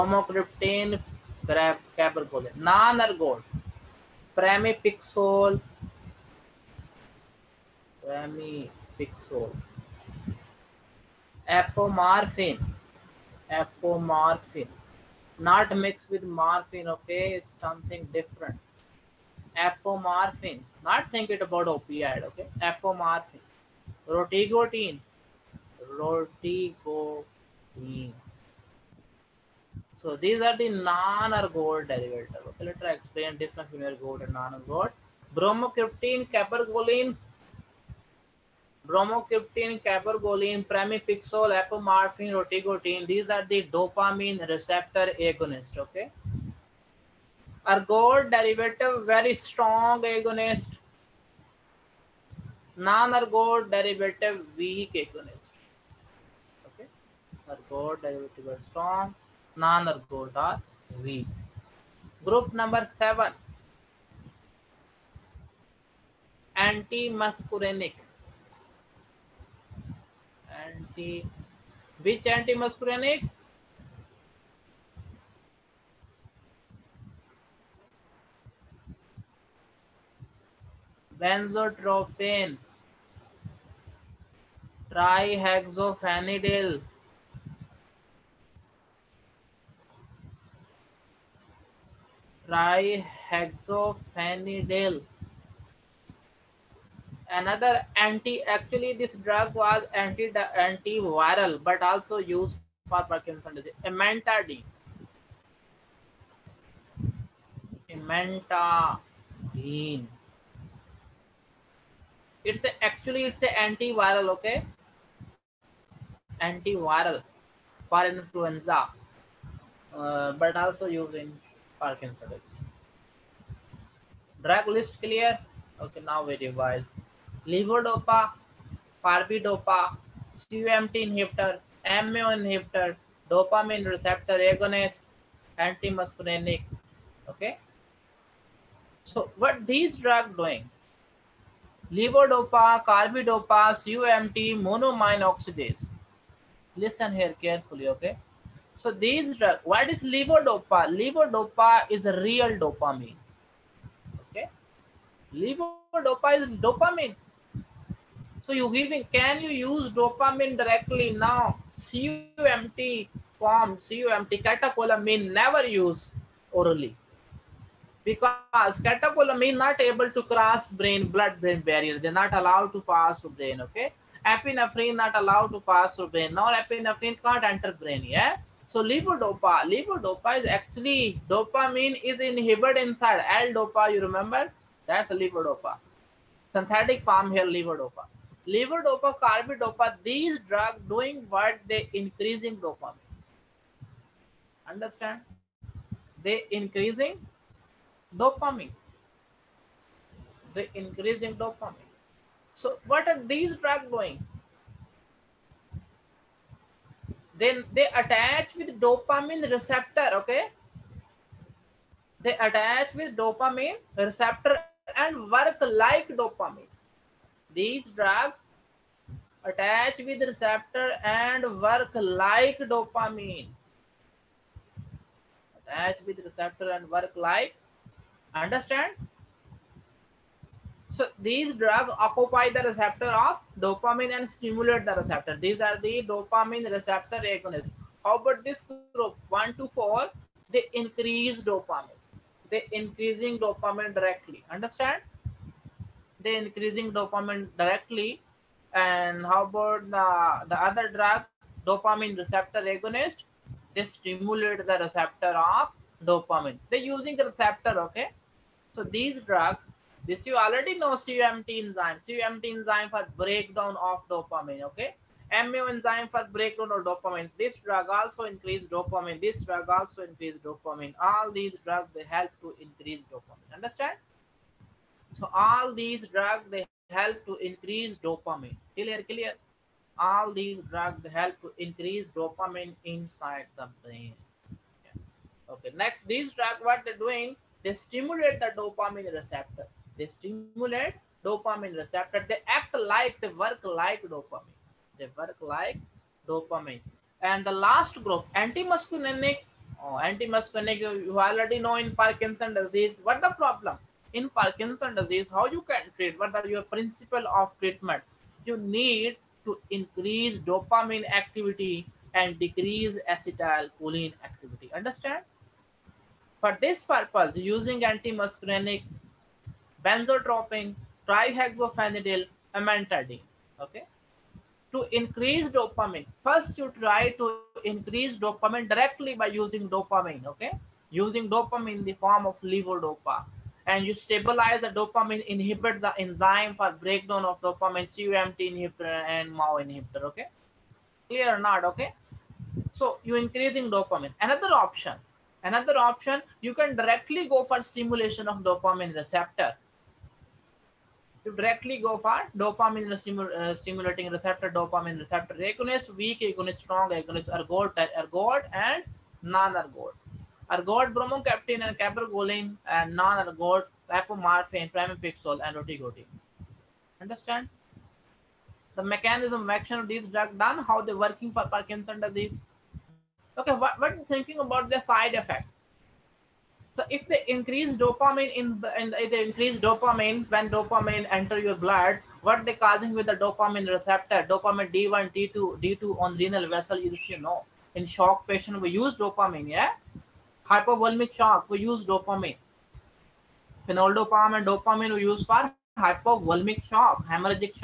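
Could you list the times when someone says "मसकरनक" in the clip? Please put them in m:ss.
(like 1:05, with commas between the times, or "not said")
1:12, 2:15.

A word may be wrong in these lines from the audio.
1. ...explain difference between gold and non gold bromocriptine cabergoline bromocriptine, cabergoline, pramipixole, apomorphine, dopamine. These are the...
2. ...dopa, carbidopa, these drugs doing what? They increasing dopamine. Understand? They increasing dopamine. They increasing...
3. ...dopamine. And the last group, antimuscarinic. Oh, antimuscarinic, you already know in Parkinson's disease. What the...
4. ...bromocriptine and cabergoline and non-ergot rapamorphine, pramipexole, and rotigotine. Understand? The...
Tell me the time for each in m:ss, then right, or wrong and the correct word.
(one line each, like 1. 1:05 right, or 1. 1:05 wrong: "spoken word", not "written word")
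1. 0:32 wrong: "rotigotine", not "dopamine"
2. 3:09 right
3. 4:56 right
4. 6:00 right.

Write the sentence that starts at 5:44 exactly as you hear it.
Another option, another option, you can directly go for stimulation of dopamine receptor.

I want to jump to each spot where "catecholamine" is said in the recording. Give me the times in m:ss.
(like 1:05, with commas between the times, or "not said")
2:44, 2:48.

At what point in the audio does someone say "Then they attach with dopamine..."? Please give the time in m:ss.
3:27.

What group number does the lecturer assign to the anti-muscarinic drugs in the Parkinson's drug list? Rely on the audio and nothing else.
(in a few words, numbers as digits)
7.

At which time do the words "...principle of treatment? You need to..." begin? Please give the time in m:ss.
5:06.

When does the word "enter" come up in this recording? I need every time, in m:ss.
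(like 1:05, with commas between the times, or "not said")
2:57, 6:21.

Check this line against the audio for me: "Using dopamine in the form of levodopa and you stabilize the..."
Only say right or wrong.
right.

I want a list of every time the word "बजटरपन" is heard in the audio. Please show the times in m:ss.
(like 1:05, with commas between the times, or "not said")
1:21.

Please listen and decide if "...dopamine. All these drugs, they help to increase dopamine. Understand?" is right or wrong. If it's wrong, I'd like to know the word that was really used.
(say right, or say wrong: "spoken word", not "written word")
right.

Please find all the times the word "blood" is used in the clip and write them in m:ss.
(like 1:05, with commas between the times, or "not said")
2:51, 6:21.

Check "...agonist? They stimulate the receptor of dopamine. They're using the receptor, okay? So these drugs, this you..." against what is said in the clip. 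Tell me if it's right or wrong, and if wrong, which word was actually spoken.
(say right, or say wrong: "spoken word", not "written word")
right.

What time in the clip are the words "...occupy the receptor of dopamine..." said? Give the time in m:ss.
3:51.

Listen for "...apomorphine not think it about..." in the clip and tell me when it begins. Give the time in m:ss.
0:19.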